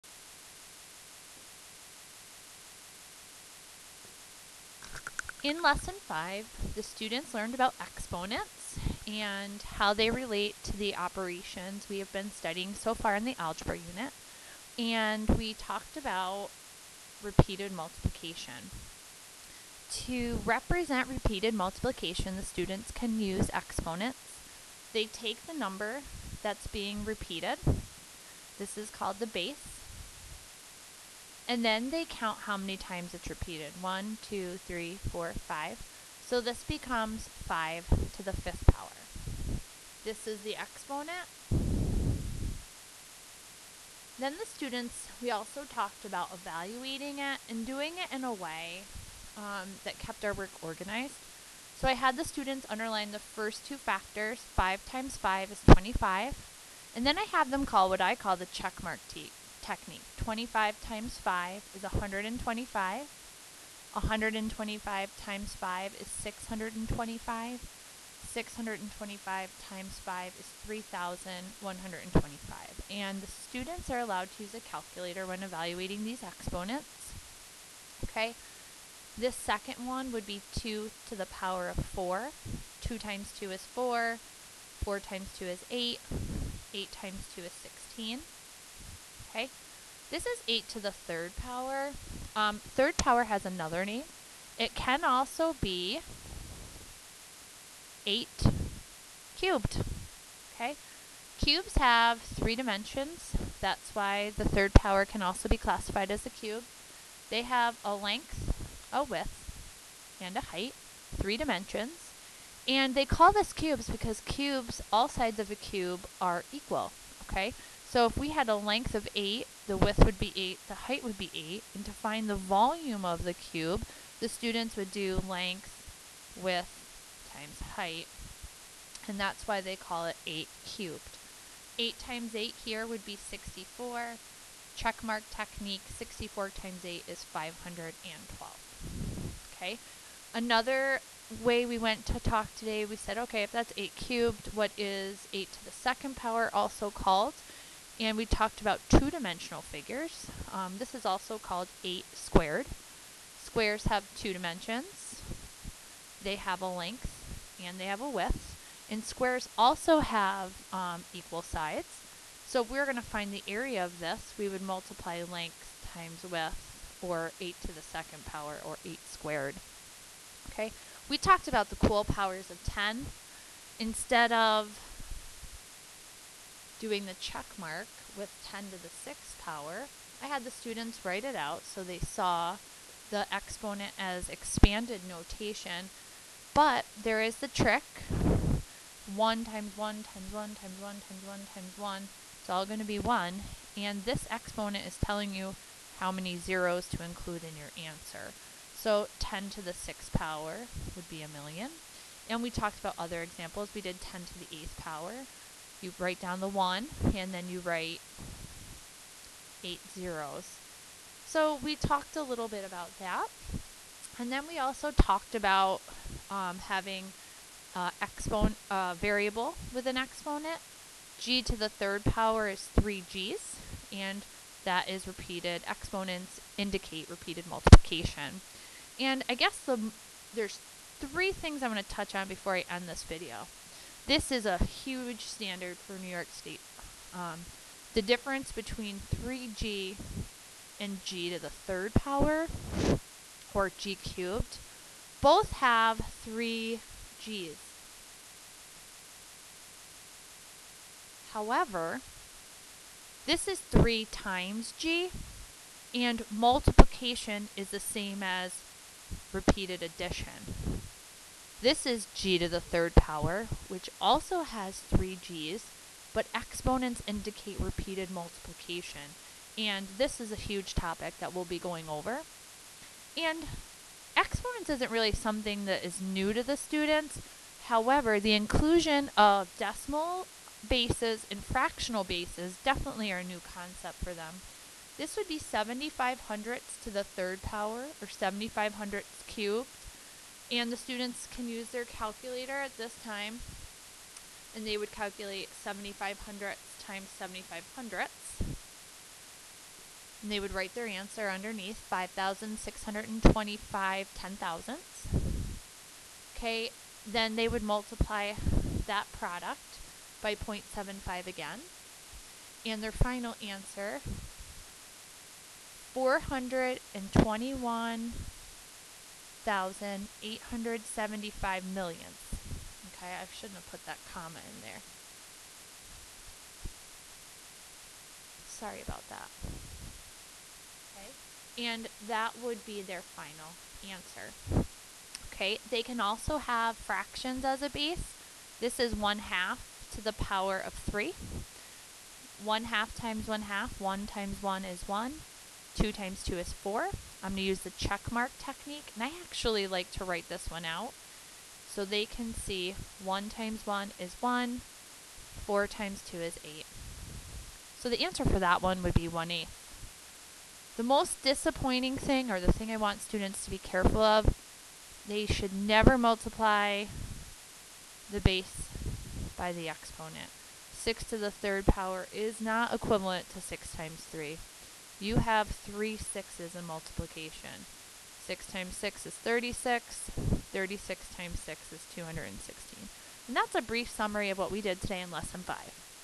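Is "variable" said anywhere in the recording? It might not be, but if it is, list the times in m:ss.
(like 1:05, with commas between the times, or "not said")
3:38.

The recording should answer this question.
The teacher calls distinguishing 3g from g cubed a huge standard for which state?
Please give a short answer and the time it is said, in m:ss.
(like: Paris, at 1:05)
New York, at 3:55.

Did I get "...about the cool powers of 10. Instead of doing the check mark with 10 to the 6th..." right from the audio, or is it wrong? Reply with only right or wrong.
right.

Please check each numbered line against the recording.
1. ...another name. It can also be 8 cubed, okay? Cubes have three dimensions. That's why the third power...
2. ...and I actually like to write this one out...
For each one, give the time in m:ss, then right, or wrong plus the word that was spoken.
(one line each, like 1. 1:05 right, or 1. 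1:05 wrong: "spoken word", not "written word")
1. 1:33 right
2. 5:48 right.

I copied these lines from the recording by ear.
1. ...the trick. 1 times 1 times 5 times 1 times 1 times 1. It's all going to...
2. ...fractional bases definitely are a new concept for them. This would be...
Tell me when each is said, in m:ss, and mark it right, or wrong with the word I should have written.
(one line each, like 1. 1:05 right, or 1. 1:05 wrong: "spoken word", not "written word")
1. 3:07 wrong: "1", not "5"
2. 4:41 right.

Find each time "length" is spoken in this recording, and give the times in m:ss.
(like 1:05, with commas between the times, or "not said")
1:47, 1:58, 2:05, 2:36, 2:45.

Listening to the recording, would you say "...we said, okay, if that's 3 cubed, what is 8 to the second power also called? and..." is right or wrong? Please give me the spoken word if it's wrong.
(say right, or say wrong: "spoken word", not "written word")
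wrong: "8", not "3".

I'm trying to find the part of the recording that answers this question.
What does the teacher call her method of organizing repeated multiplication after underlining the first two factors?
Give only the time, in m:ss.
2:14.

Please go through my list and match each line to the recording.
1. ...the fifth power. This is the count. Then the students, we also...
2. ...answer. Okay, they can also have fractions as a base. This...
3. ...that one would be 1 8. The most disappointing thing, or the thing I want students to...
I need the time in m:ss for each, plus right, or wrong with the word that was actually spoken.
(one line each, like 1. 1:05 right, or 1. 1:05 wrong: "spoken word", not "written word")
1. 0:38 wrong: "exponent", not "count"
2. 5:33 right
3. 5:58 right.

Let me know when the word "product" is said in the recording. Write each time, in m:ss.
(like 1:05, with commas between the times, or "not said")
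5:09.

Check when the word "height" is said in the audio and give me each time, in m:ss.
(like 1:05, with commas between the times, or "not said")
1:50, 2:00, 2:07.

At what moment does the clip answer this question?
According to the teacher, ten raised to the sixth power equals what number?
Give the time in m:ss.
3:21.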